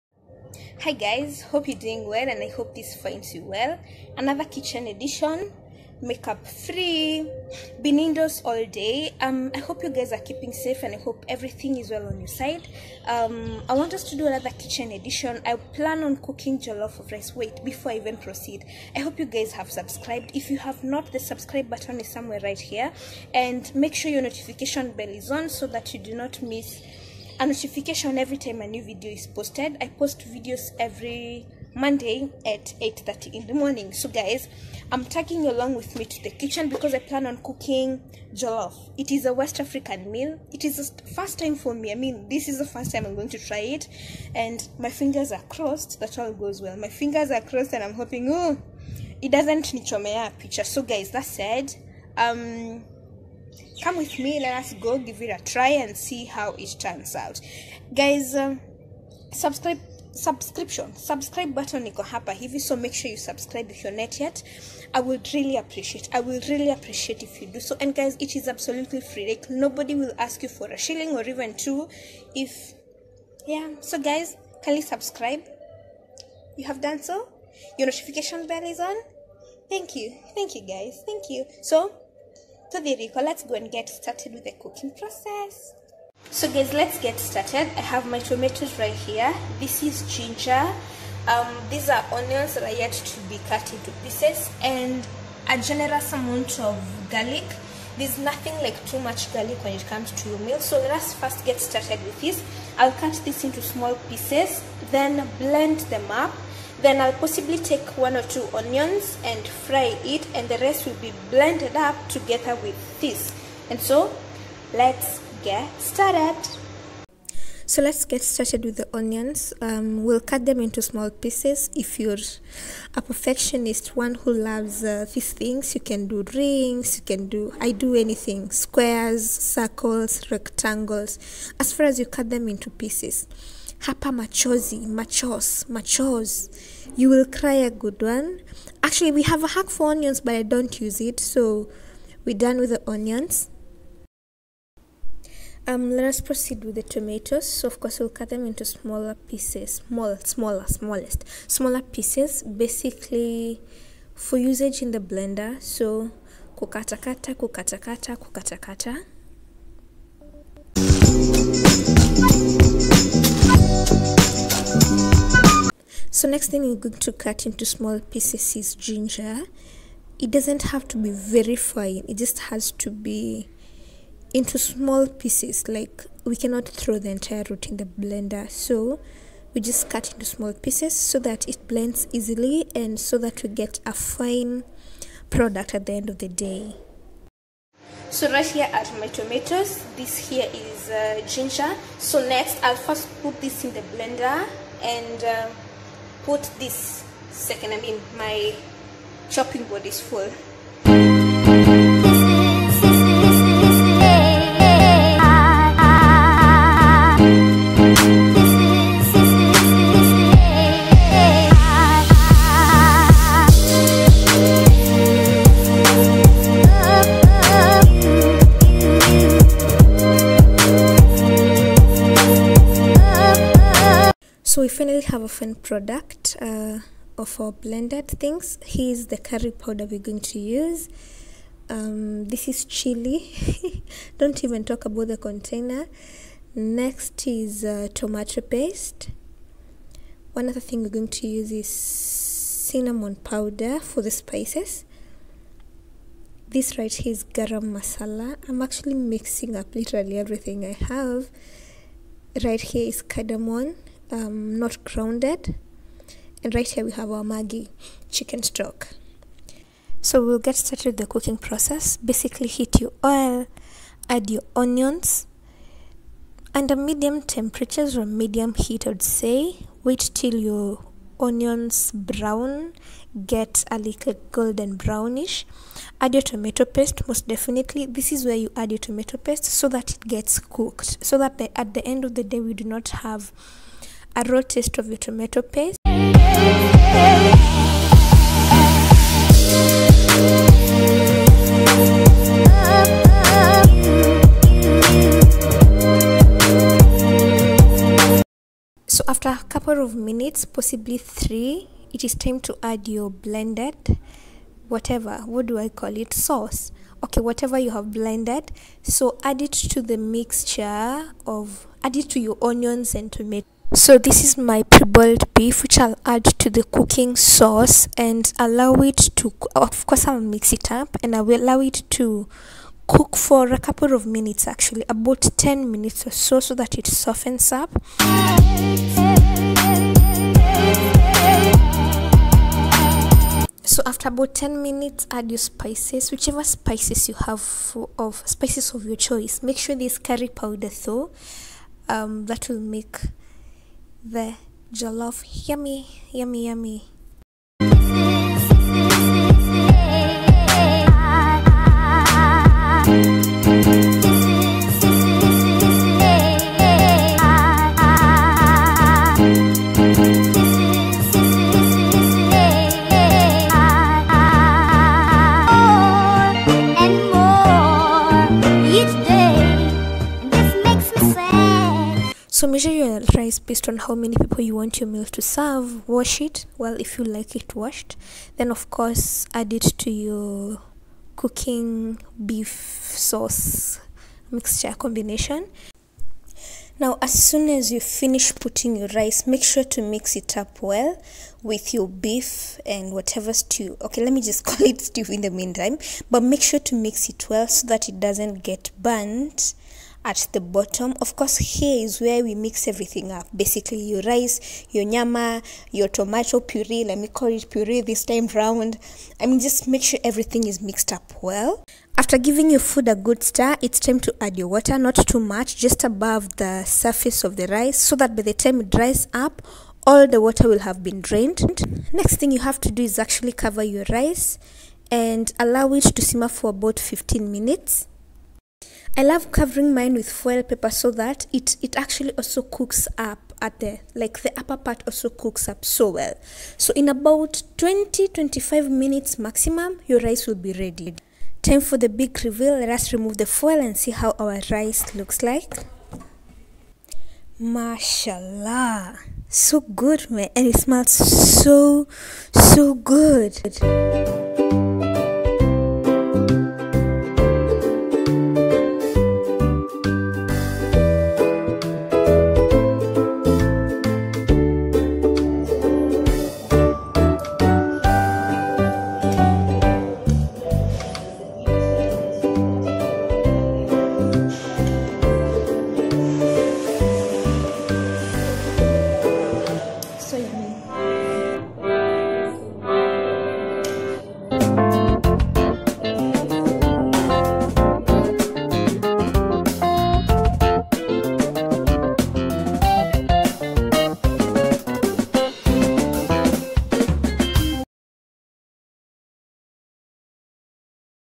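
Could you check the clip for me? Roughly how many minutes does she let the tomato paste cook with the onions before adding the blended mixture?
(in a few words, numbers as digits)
3.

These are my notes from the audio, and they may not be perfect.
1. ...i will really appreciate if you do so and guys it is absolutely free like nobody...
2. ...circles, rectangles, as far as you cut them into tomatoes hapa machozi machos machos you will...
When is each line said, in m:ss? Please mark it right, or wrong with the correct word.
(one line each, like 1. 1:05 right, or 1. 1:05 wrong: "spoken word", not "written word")
1. 1:06 right
2. 2:09 wrong: "pieces", not "tomatoes".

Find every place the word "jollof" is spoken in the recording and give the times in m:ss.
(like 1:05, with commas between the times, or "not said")
0:16, 0:38, 5:44.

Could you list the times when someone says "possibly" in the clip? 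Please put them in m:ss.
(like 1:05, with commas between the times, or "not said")
1:47, 5:00.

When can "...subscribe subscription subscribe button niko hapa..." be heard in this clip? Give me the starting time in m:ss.
0:59.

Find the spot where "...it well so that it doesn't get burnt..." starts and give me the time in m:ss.
6:37.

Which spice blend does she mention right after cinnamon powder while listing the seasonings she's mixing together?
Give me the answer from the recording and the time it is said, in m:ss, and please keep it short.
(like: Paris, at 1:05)
garam masala, at 4:07.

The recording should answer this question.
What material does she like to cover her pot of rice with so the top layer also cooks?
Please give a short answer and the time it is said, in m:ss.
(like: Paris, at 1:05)
foil paper, at 7:10.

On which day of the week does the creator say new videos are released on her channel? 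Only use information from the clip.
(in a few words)
Monday.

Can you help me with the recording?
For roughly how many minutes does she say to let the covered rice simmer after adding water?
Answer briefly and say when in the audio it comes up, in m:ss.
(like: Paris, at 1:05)
15 minutes, at 7:06.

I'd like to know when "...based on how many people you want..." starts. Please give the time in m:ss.
6:13.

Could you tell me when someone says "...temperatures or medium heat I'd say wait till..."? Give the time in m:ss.
4:27.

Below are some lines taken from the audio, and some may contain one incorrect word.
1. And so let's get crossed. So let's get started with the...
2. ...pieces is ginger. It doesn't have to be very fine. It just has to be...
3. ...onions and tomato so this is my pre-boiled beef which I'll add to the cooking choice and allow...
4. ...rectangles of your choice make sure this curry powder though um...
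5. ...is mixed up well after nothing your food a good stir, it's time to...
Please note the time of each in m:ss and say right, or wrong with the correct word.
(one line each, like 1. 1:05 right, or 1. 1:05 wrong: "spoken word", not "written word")
1. 1:53 wrong: "started", not "crossed"
2. 2:47 right
3. 5:12 wrong: "sauce", not "choice"
4. 5:38 wrong: "spices", not "rectangles"
5. 6:50 wrong: "giving", not "nothing".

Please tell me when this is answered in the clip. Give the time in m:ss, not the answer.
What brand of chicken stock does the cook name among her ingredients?
4:17.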